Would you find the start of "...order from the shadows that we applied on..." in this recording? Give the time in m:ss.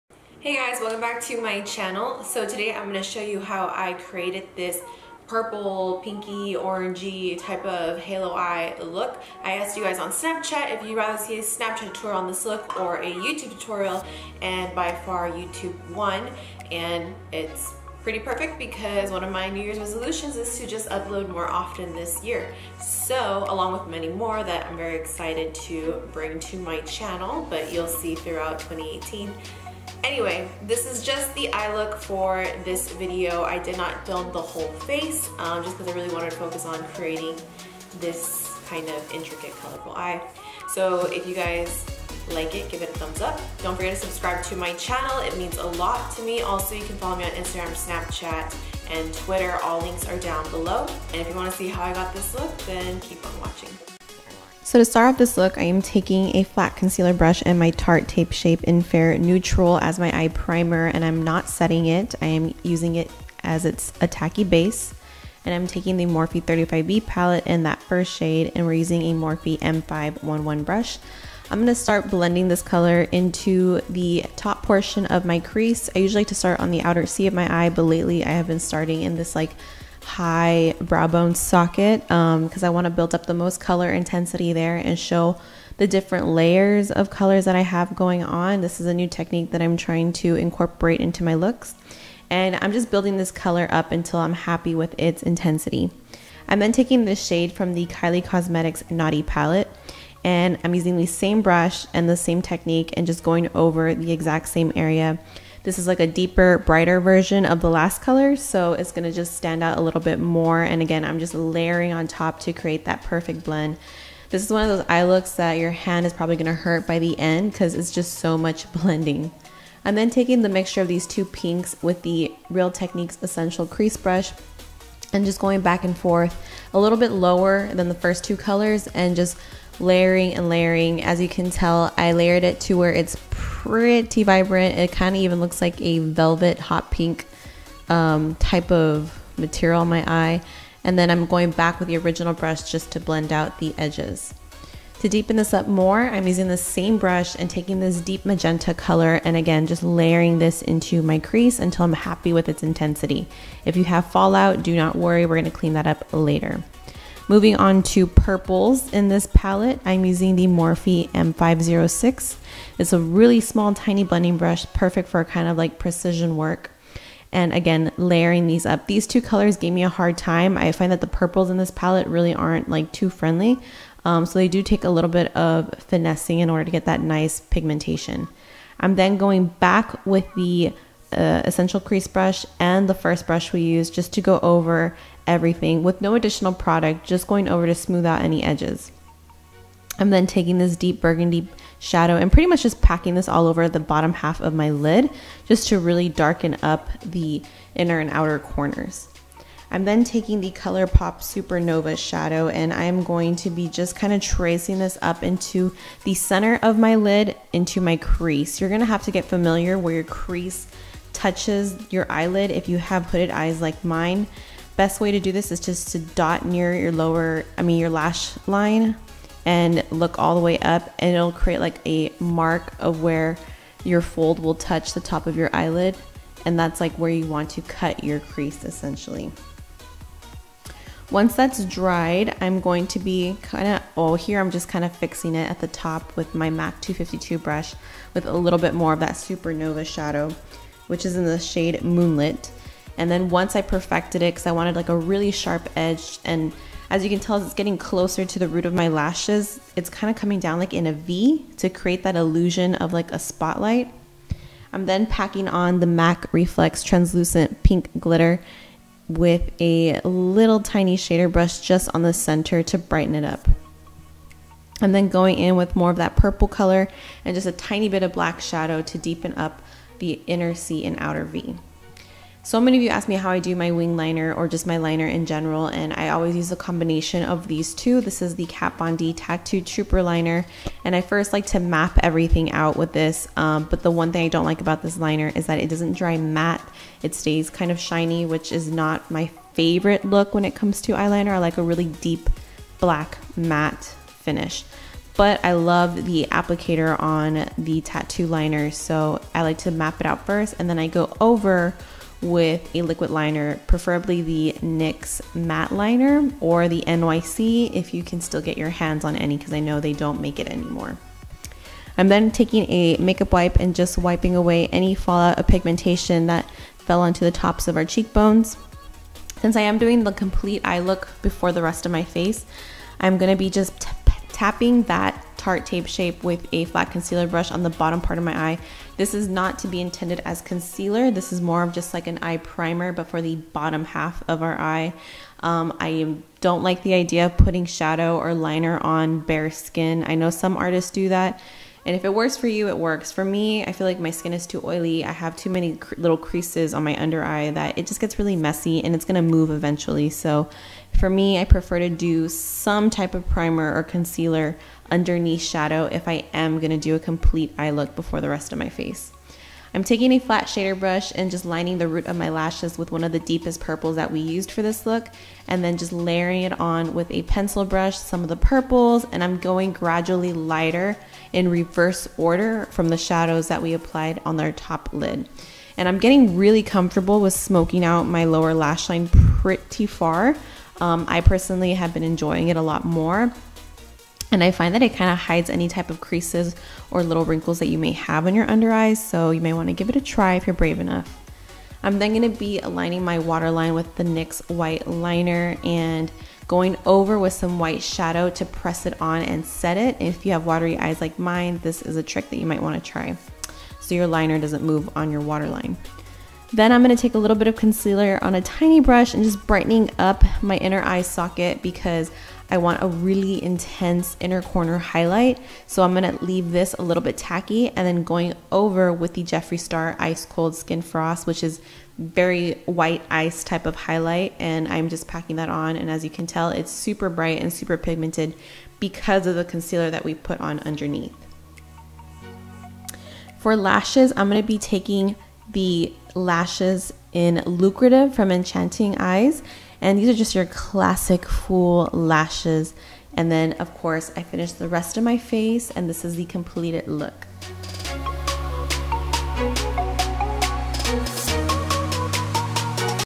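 6:12.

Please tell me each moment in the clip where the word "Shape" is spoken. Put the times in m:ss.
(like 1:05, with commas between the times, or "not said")
0:58, 5:25.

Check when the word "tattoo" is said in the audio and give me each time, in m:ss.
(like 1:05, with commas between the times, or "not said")
4:39, 4:57.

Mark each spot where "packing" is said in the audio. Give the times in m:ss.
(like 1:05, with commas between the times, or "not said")
3:12, 4:15, 7:05.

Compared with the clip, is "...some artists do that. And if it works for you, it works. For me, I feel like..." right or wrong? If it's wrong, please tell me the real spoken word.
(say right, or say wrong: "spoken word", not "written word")
right.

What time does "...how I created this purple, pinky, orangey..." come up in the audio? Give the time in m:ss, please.
0:03.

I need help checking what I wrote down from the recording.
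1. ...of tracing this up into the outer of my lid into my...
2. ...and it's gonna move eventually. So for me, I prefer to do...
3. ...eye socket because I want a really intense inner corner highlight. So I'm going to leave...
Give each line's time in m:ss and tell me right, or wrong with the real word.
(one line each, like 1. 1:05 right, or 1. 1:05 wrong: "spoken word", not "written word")
1. 3:24 wrong: "center", not "outer"
2. 5:48 right
3. 6:50 right.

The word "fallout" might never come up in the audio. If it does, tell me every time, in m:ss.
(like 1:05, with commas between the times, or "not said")
2:34, 5:14.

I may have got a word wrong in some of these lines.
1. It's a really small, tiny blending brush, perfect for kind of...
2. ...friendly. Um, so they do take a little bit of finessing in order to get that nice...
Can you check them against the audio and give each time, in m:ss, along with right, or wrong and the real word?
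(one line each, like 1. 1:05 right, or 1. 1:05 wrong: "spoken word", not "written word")
1. 2:42 right
2. 2:53 right.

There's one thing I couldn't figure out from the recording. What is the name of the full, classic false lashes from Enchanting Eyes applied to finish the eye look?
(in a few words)
Lucrative.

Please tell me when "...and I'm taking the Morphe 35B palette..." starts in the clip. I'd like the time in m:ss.
1:05.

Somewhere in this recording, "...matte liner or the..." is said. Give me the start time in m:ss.
5:05.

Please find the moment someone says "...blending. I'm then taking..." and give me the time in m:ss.
1:58.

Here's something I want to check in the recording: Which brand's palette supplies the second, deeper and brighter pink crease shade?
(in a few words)
Kylie Cosmetics.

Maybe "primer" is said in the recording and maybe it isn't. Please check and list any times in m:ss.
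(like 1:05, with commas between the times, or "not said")
1:00, 5:32, 5:53.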